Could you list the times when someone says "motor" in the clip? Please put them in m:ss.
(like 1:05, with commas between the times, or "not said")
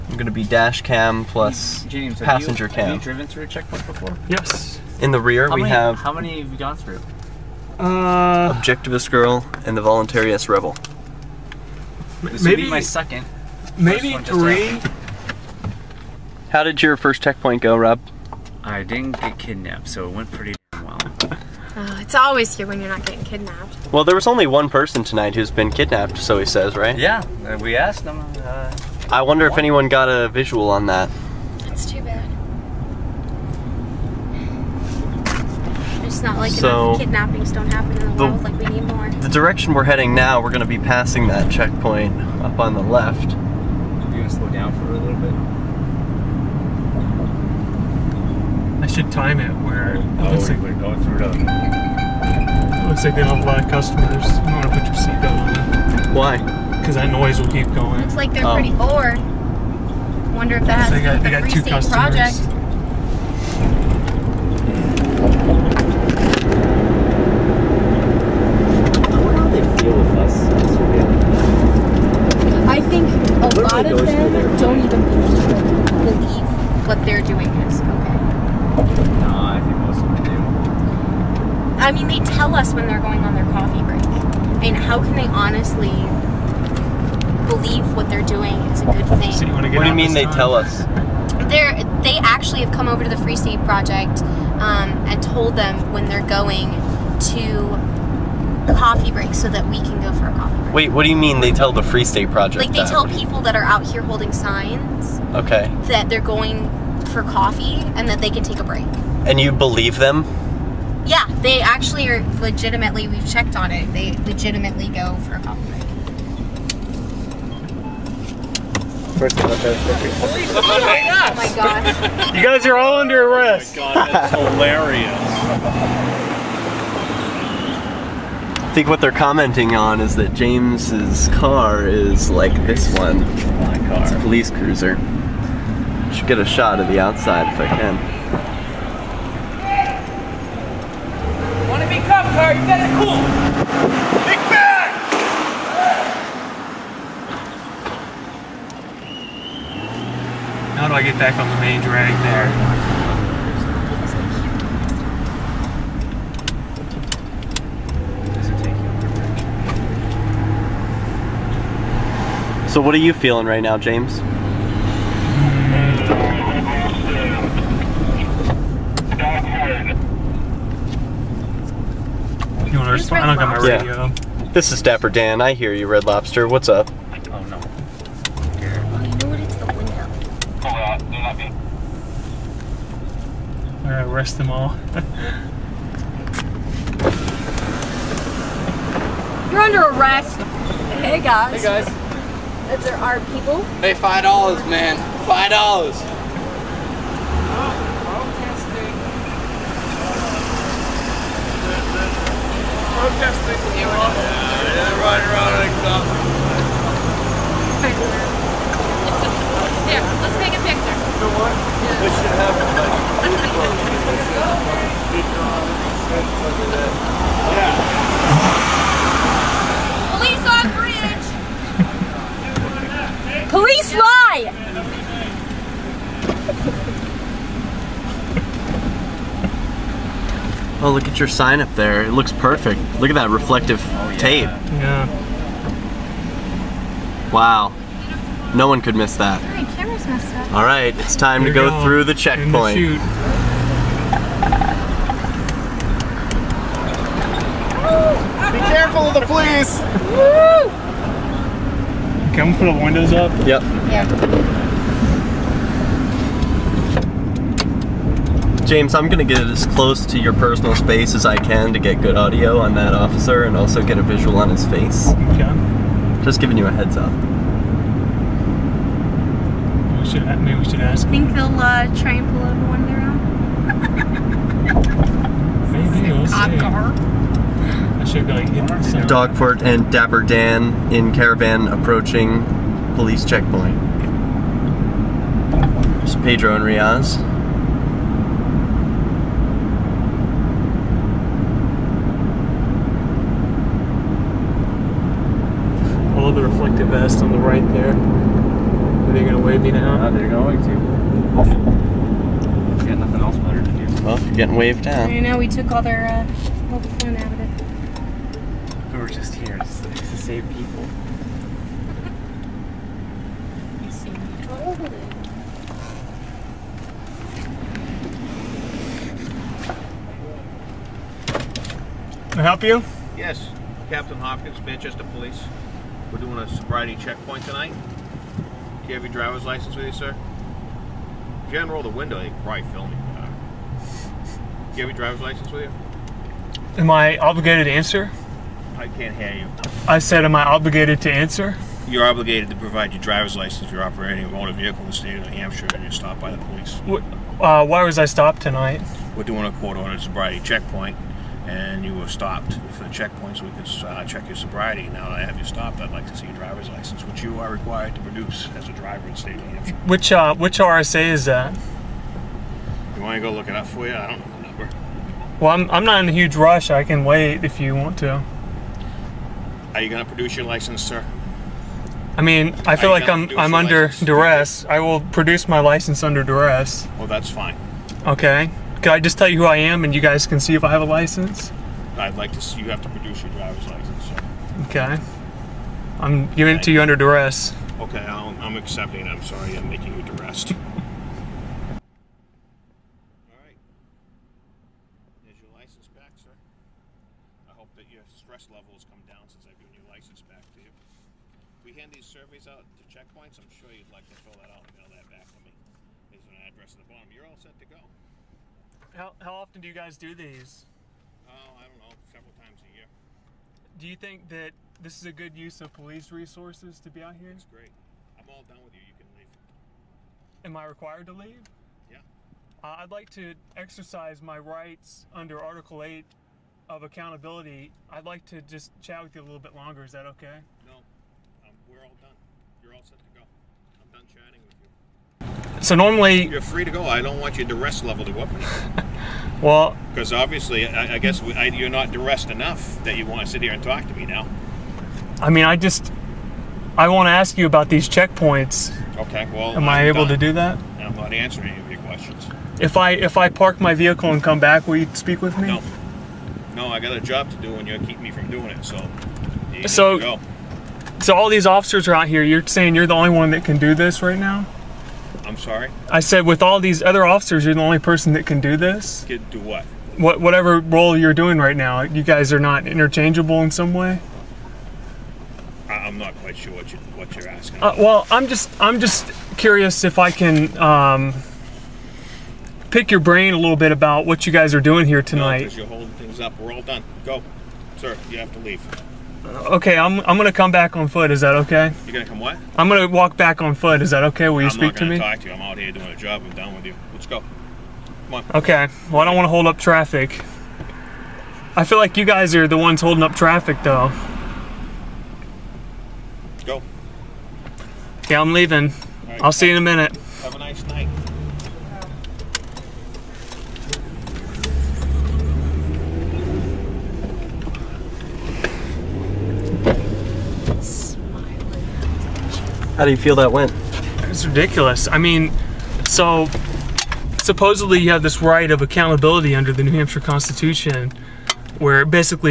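5:44.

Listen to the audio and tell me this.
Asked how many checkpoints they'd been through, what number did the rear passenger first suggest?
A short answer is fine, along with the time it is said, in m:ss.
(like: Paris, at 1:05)
second, at 0:12.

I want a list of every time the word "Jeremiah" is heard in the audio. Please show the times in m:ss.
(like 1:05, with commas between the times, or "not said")
not said.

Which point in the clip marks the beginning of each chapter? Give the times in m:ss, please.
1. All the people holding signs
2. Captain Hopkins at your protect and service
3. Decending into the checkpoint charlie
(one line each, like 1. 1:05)
1. 3:03
2. 5:09
3. 4:04.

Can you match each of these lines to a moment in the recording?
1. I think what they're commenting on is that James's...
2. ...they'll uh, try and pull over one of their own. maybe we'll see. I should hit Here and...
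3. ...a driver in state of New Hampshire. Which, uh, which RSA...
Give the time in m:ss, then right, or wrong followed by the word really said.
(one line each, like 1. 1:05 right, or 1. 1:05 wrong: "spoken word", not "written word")
1. 2:08 right
2. 4:31 wrong: "Dogfort", not "Here"
3. 5:58 right.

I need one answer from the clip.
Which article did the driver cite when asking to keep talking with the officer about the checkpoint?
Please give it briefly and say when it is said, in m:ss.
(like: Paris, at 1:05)
Article 8, at 7:05.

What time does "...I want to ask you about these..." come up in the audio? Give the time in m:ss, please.
7:26.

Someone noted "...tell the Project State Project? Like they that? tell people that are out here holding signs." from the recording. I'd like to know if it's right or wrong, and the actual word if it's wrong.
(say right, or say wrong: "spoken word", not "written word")
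wrong: "Free", not "Project".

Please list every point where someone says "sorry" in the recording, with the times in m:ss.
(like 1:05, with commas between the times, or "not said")
6:29, 7:45.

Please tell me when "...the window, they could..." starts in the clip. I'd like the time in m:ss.
5:31.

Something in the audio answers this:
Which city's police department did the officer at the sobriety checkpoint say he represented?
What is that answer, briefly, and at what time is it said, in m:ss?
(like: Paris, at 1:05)
Manchester, at 5:24.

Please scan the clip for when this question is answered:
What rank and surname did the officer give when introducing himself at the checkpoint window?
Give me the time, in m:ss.
5:23.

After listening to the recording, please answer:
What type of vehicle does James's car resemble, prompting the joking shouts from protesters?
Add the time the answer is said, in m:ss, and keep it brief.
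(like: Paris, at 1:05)
police cruiser, at 2:14.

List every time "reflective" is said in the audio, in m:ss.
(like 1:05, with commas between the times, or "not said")
3:53, 4:56.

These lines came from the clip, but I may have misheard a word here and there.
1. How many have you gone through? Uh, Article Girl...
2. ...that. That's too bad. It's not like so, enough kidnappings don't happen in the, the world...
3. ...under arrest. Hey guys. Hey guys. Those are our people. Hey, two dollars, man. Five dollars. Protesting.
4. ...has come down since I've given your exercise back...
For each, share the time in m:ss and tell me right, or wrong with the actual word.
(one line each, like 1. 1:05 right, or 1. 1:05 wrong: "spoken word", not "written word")
1. 0:05 wrong: "Objectivist", not "Article"
2. 0:30 right
3. 3:09 wrong: "five", not "two"
4. 6:38 wrong: "license", not "exercise".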